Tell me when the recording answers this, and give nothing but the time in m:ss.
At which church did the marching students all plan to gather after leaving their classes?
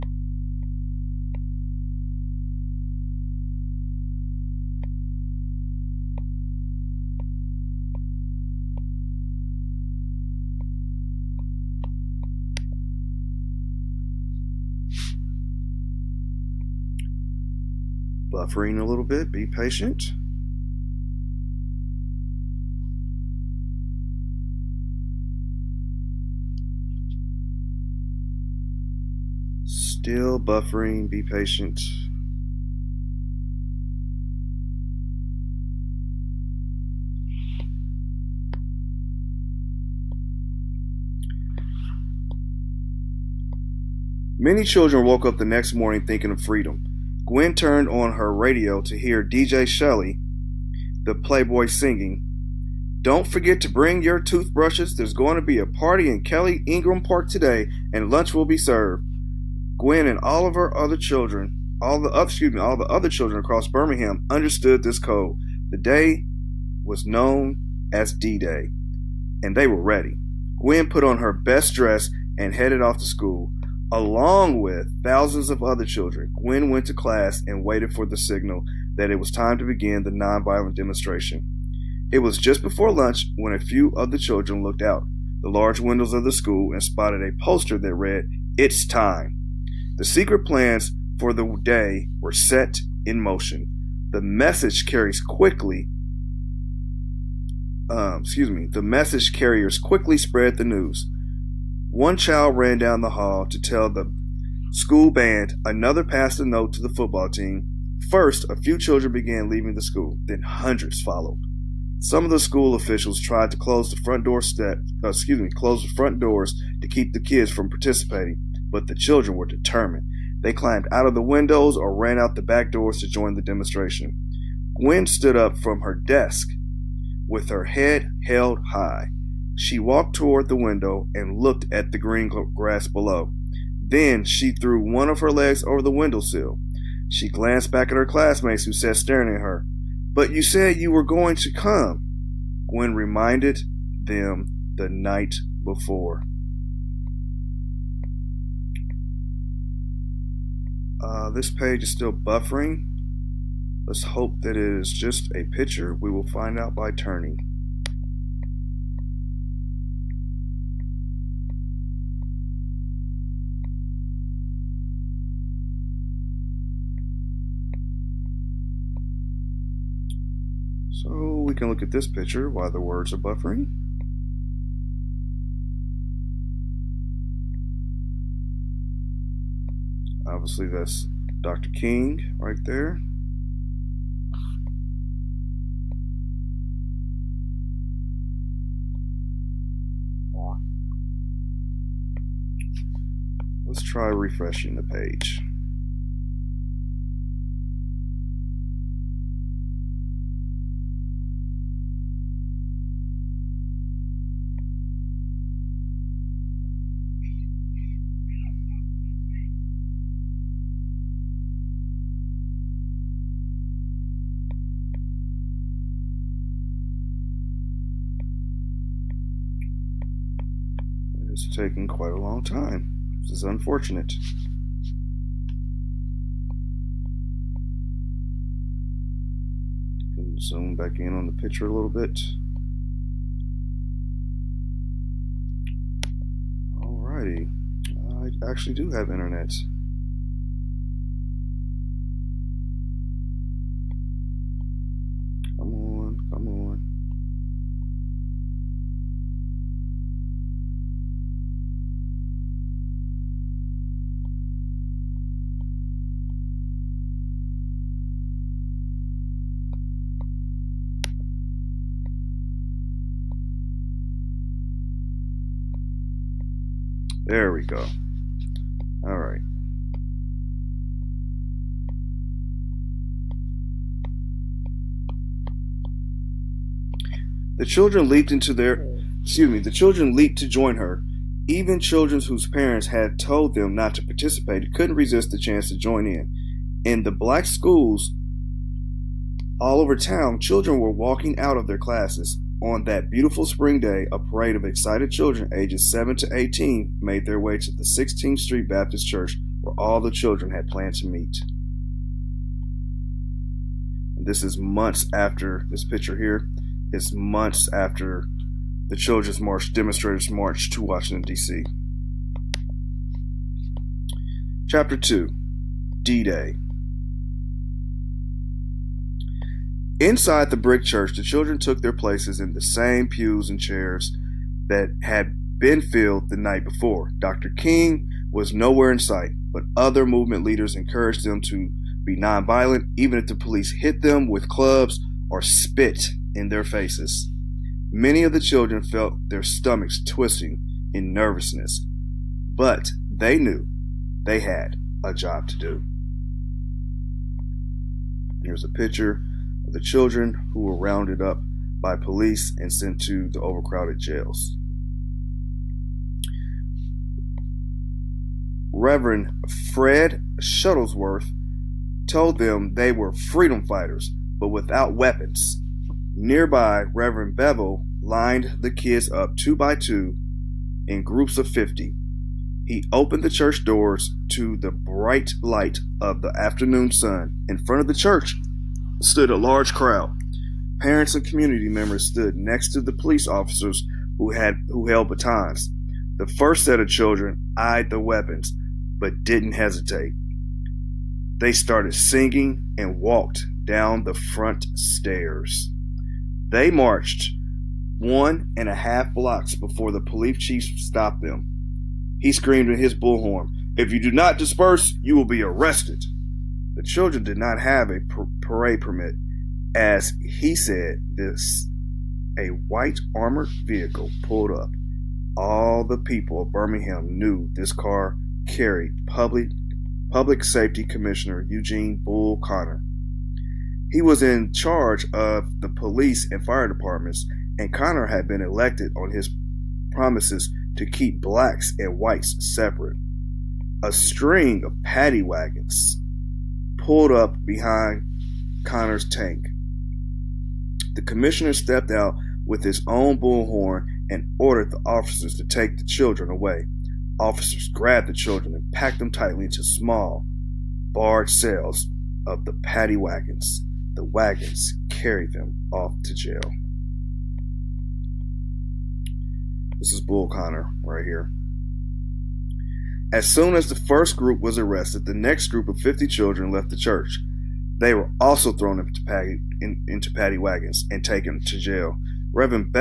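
4:57.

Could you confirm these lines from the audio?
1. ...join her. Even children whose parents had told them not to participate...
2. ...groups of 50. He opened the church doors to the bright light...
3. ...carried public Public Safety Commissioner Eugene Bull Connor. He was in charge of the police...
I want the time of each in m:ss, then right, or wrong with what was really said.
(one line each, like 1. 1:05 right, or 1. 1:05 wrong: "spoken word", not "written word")
1. 4:40 right
2. 6:11 right
3. 6:58 right.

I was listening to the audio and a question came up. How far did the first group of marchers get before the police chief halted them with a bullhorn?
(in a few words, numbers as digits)
1.5 blocks.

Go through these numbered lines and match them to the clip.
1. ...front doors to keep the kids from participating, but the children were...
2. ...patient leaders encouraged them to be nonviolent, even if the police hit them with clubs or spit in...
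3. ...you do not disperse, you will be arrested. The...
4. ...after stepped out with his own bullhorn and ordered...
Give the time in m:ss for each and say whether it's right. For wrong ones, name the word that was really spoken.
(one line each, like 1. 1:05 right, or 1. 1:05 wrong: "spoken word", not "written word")
1. 1:55 right
2. 5:30 wrong: "movement", not "patient"
3. 6:43 right
4. 7:21 wrong: "commissioner", not "after".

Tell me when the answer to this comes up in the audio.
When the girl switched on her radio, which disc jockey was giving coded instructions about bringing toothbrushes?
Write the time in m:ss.
0:49.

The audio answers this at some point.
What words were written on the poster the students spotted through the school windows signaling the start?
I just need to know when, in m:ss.
1:28.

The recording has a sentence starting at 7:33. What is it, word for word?
The wagons carried them off to jail.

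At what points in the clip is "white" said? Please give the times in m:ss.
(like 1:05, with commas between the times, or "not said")
6:52, 7:11.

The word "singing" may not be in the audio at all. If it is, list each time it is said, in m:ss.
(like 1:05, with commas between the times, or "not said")
0:51, 6:31.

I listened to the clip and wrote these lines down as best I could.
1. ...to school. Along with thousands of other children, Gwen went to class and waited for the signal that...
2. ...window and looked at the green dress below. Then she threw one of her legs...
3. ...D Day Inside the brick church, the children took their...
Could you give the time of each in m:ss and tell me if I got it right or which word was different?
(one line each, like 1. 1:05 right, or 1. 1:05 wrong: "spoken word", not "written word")
1. 1:12 right
2. 2:10 wrong: "grass", not "dress"
3. 5:16 right.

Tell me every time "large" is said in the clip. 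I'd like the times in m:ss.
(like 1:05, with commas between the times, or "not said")
1:25, 6:19.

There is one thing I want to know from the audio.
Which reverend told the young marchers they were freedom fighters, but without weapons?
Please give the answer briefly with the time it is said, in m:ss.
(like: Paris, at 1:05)
Fred Shuttlesworth, at 5:59.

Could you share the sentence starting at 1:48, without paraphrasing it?
First, a few children began leaving the school, then hundreds followed.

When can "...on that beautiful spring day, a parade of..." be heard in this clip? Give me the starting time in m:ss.
4:52.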